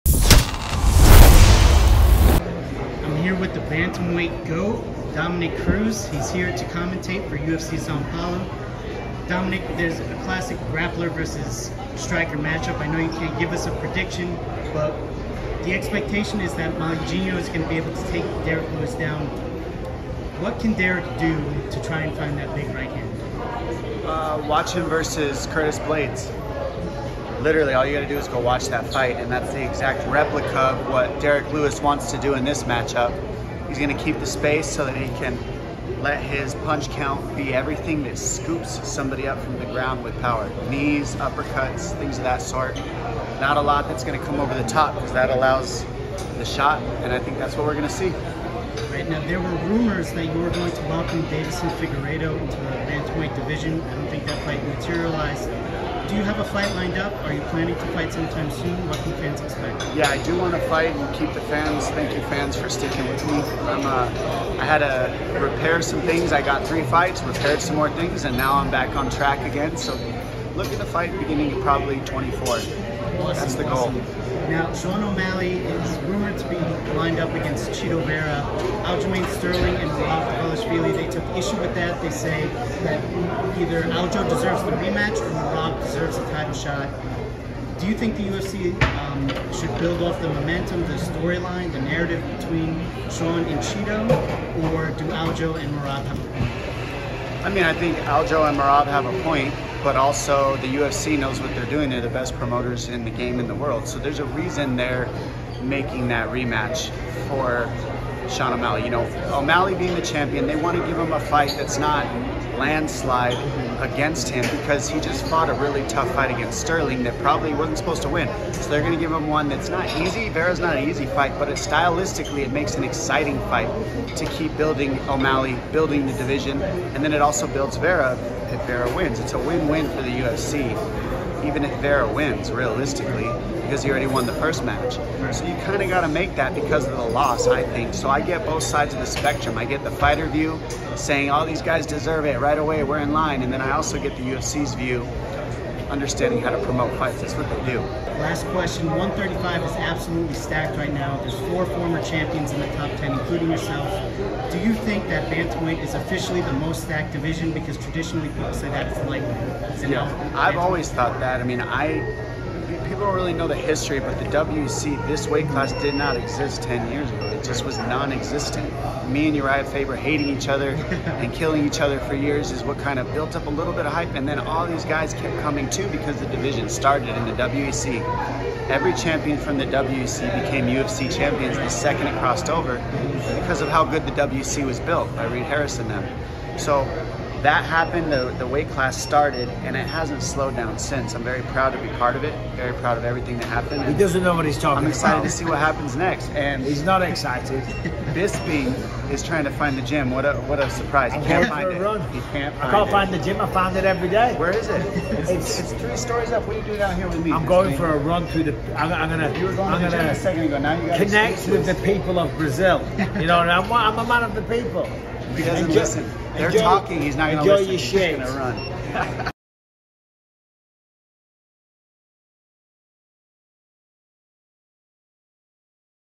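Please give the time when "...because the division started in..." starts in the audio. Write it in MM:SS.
02:55.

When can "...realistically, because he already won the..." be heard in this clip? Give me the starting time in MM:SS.
02:12.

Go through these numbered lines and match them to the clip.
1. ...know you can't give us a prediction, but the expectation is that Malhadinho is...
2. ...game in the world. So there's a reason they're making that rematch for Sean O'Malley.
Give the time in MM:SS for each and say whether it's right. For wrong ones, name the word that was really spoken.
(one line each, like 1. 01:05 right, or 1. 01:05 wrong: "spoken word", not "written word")
1. 00:12 right
2. 01:43 right.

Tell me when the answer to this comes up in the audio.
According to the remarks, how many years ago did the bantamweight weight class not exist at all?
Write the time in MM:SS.
02:46.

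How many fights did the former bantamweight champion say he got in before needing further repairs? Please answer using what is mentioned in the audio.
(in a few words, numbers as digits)
3.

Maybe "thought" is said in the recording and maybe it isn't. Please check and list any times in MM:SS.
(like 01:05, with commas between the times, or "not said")
02:40.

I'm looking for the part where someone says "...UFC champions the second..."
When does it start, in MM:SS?
03:00.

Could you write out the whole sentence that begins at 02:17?
So I get both sides of the spectrum.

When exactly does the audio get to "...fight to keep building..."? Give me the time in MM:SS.
02:03.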